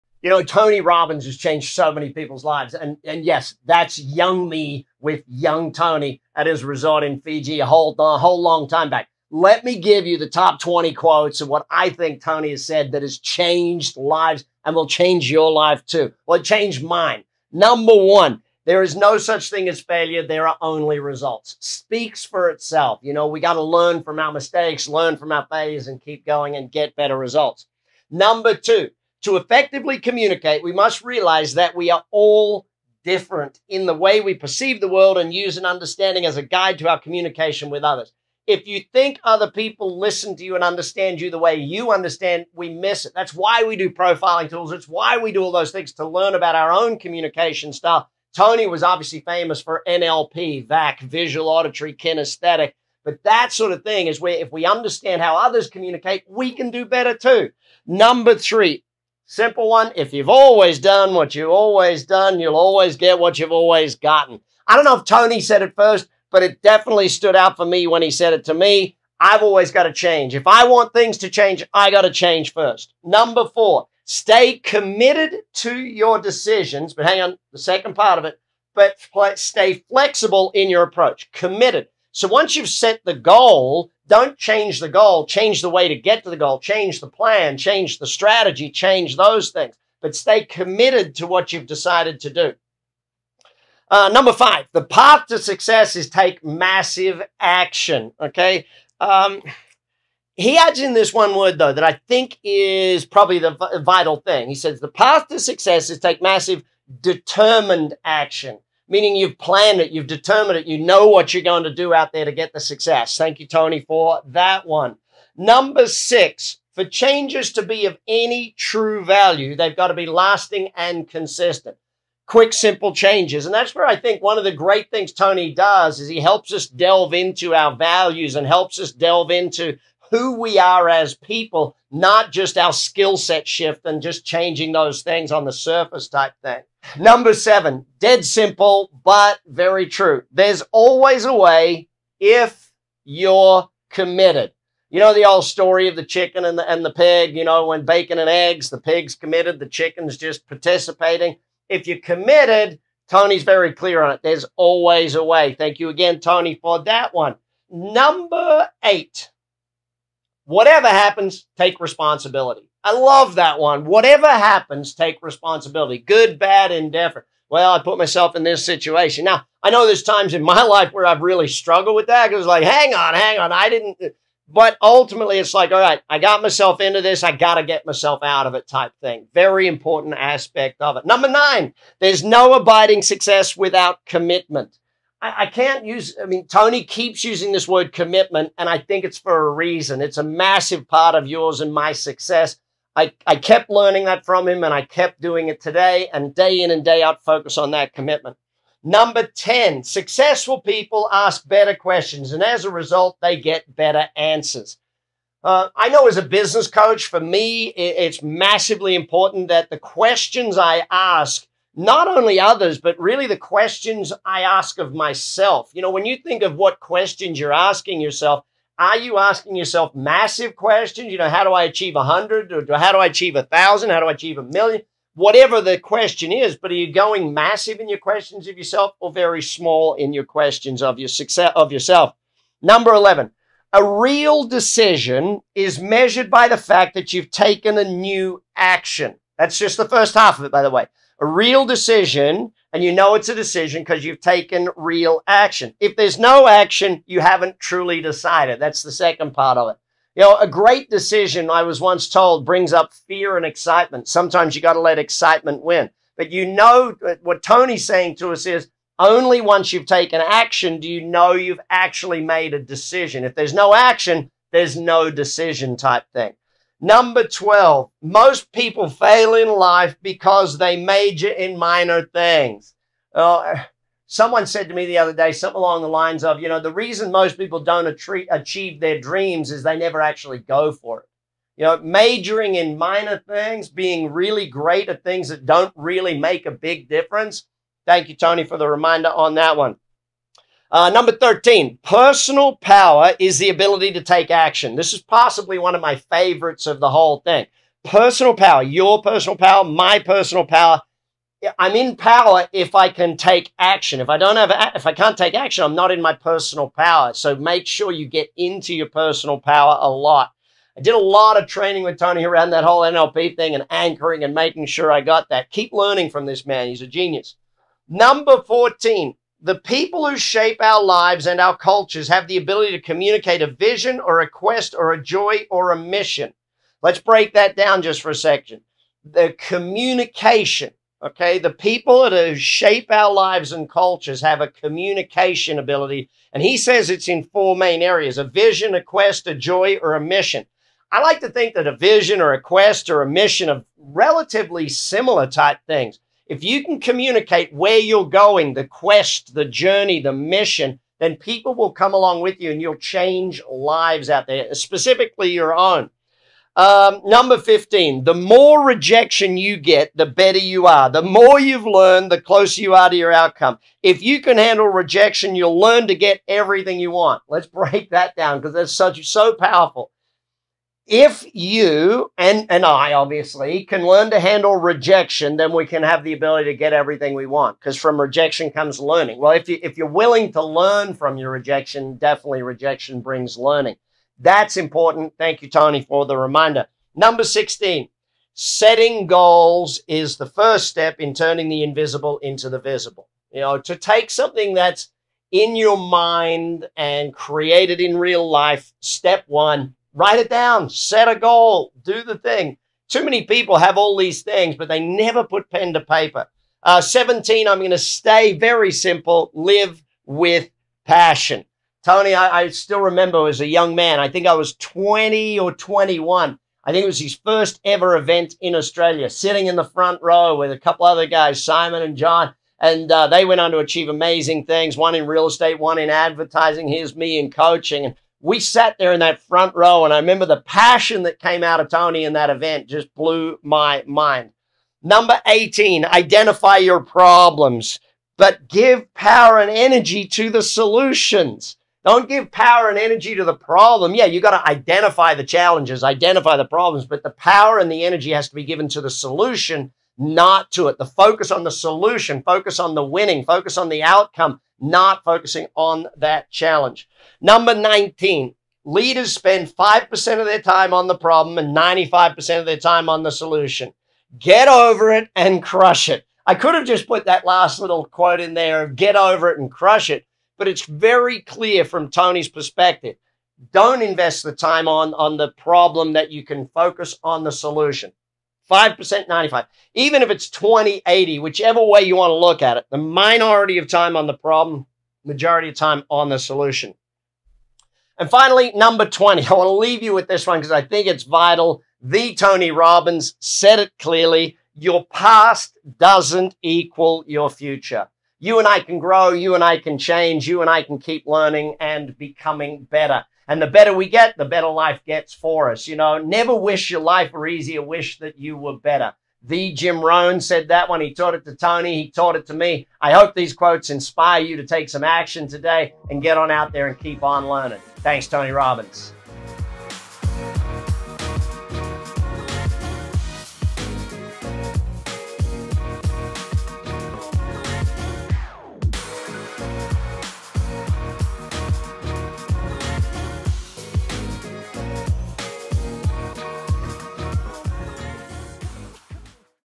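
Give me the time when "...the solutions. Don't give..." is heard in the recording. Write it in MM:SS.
07:20.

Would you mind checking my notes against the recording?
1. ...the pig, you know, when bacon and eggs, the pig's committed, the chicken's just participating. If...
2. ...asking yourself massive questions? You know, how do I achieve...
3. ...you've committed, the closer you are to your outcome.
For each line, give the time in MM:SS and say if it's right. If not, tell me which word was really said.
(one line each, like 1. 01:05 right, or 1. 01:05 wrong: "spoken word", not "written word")
1. 02:26 right
2. 03:39 right
3. 06:01 wrong: "learned", not "committed".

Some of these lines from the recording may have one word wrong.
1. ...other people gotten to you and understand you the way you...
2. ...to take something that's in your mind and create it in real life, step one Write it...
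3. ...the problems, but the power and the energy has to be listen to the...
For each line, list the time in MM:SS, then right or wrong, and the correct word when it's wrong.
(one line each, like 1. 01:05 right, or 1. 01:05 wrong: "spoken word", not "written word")
1. 00:39 wrong: "listen", not "gotten"
2. 06:33 right
3. 07:26 wrong: "given", not "listen".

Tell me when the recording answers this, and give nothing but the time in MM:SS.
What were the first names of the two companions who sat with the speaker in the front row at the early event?
07:01.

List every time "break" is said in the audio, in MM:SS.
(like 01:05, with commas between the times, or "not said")
05:26, 06:07.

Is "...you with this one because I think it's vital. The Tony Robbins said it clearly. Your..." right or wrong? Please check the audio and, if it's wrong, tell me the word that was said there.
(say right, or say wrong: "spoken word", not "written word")
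right.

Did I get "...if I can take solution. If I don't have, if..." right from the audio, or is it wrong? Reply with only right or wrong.
wrong.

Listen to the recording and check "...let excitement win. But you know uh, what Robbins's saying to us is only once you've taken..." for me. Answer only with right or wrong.
wrong.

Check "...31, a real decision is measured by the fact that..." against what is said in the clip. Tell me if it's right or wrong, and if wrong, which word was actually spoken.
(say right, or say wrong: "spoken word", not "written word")
wrong: "11", not "31".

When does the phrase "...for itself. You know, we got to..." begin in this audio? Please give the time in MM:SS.
00:22.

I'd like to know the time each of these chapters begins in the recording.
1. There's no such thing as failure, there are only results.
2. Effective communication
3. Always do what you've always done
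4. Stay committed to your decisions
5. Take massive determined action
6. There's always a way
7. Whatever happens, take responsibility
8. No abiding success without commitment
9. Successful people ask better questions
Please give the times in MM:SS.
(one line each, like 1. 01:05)
1. 00:19
2. 00:31
3. 01:01
4. 01:15
5. 01:36
6. 02:22
7. 02:41
8. 03:02
9. 03:19.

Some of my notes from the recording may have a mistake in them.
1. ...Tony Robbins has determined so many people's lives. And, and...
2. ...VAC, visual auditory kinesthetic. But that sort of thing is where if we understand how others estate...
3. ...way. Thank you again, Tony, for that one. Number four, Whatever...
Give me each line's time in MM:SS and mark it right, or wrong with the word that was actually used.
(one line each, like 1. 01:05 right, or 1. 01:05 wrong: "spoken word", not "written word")
1. 00:00 wrong: "changed", not "determined"
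2. 00:50 wrong: "communicate", not "estate"
3. 02:35 wrong: "eight", not "four".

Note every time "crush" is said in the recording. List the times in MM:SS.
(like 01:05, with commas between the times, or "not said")
07:45, 07:49.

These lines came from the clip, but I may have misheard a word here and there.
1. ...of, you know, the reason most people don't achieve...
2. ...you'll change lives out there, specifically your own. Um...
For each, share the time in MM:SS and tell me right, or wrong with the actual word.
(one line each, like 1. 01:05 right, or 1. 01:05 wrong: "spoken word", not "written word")
1. 04:36 right
2. 05:52 right.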